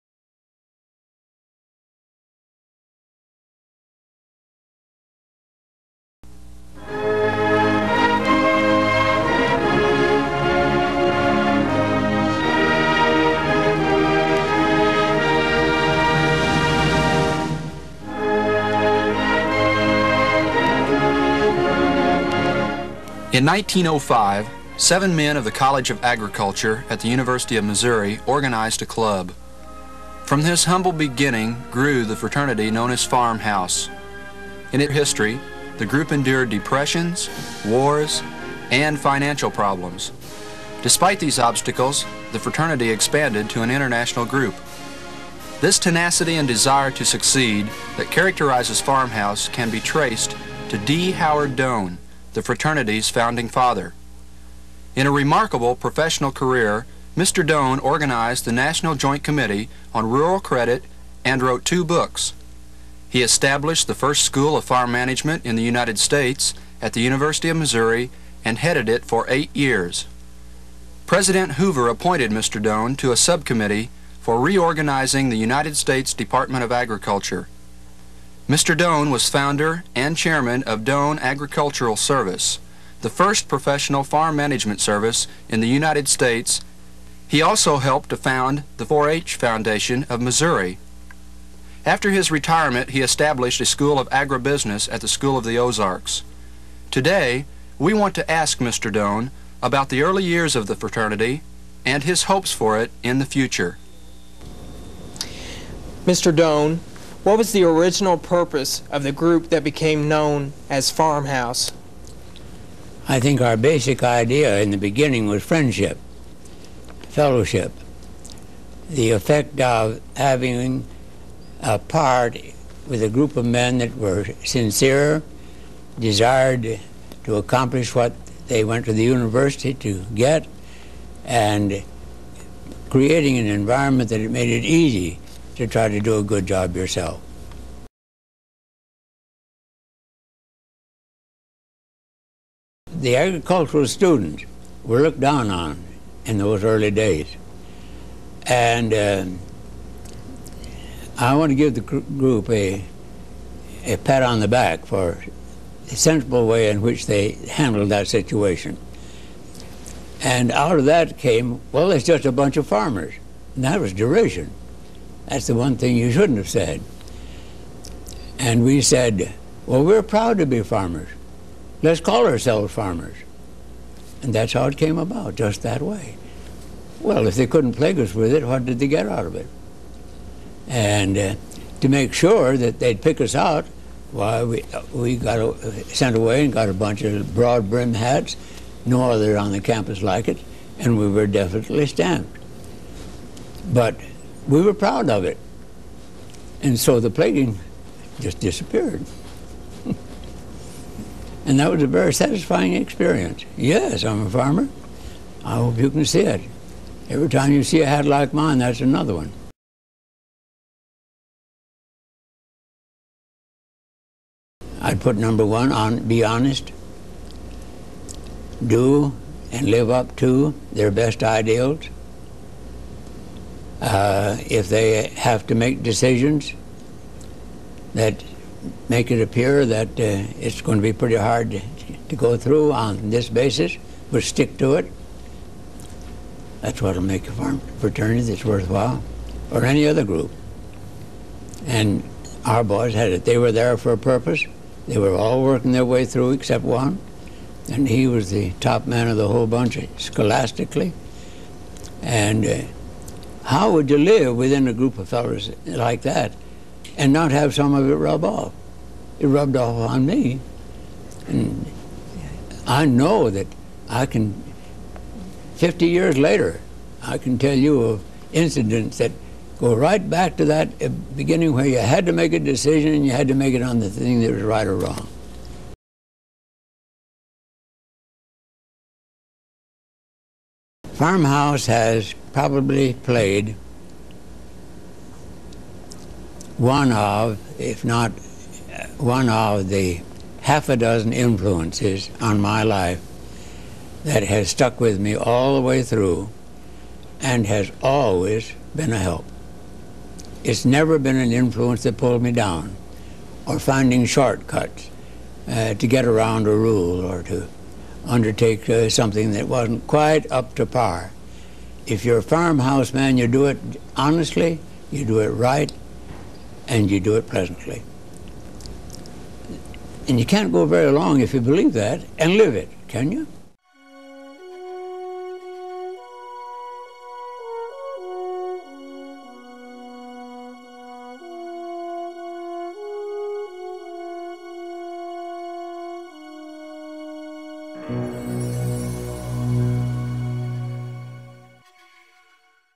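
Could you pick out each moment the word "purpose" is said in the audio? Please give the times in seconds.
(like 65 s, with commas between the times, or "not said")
108 s, 243 s.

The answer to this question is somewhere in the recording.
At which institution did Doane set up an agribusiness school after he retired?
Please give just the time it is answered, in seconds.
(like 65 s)
95 s.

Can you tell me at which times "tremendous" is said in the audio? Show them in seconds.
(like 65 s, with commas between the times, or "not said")
not said.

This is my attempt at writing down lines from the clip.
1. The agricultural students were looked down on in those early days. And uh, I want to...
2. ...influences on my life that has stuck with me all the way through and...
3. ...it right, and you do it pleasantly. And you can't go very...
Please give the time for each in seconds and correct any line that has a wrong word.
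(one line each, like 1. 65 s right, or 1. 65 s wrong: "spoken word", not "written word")
1. 142 s right
2. 291 s right
3. 315 s right.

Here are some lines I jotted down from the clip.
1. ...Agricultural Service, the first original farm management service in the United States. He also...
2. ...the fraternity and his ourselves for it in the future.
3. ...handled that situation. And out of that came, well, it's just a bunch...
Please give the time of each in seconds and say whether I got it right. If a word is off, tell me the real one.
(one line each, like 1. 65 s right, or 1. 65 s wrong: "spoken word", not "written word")
1. 81 s wrong: "professional", not "original"
2. 100 s wrong: "hopes", not "ourselves"
3. 157 s right.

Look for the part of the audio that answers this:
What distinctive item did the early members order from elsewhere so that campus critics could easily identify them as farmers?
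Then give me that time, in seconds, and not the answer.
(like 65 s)
187 s.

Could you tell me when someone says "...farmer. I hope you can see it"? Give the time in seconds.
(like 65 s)
204 s.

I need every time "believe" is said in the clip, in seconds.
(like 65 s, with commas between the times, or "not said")
321 s.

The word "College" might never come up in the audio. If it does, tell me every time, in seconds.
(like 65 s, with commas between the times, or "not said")
25 s.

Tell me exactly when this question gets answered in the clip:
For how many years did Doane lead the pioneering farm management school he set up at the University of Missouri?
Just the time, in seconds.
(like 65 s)
69 s.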